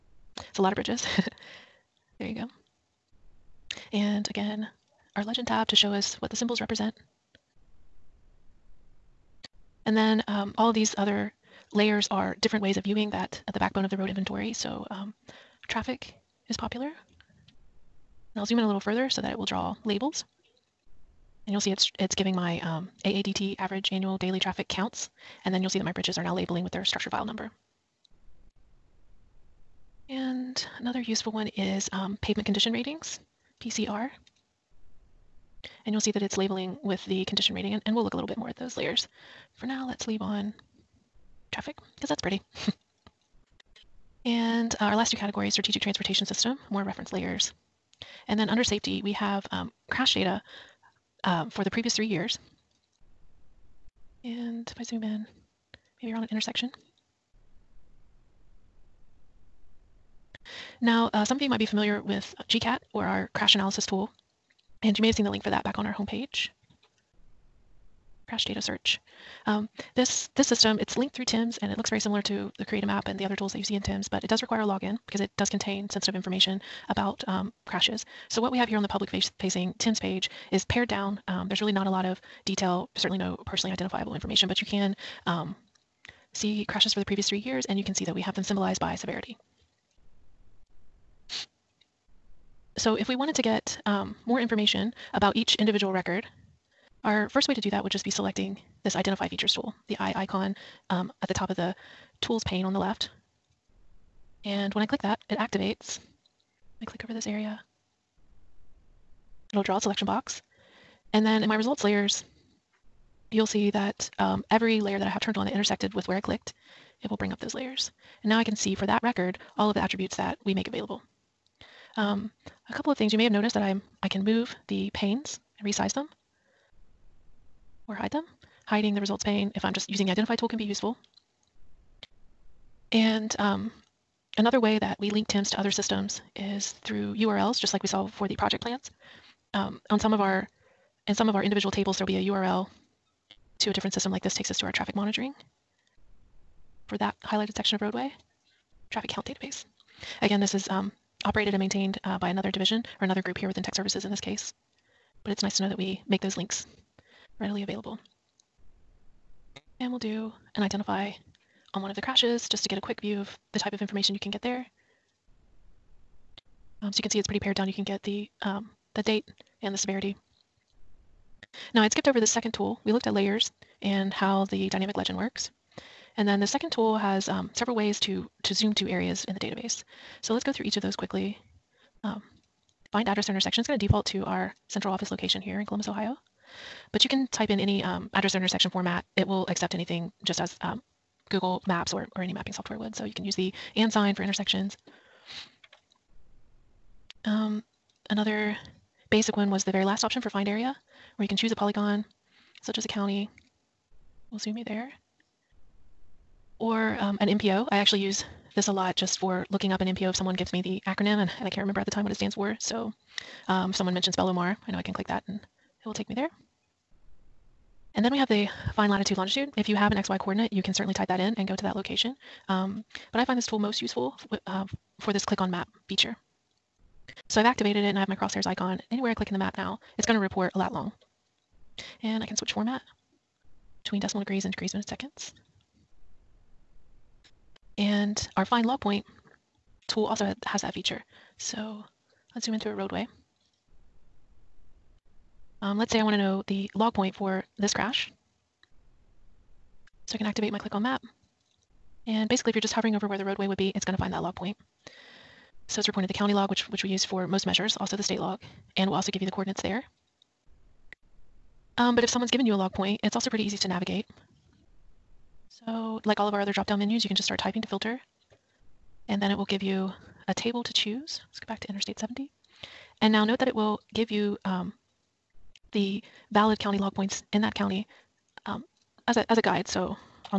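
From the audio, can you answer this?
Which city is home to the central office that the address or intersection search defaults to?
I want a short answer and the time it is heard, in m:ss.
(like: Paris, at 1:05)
Columbus, Ohio, at 3:05.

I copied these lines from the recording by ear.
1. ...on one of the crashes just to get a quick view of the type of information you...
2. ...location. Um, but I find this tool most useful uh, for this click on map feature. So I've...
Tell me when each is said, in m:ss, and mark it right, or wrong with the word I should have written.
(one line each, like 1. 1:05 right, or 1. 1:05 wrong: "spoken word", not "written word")
1. 2:41 right
2. 3:41 right.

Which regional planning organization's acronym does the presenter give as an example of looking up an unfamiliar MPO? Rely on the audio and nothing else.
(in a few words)
Bel-O-Mar.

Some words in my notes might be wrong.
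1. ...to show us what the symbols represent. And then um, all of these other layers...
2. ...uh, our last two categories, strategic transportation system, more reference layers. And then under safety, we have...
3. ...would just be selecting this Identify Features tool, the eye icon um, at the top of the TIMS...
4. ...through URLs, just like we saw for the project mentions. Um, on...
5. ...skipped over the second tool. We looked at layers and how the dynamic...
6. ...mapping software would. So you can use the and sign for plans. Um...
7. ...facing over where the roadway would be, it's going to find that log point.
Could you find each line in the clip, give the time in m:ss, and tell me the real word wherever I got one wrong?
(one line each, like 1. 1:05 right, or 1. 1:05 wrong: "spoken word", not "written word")
1. 0:05 right
2. 0:44 right
3. 1:37 wrong: "Tools", not "TIMS"
4. 2:16 wrong: "plans", not "mentions"
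5. 2:51 right
6. 3:12 wrong: "intersections", not "plans"
7. 4:12 wrong: "hovering", not "facing".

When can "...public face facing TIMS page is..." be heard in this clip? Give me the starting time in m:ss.
1:18.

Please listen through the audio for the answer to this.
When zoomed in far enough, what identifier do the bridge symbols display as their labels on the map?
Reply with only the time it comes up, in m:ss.
0:26.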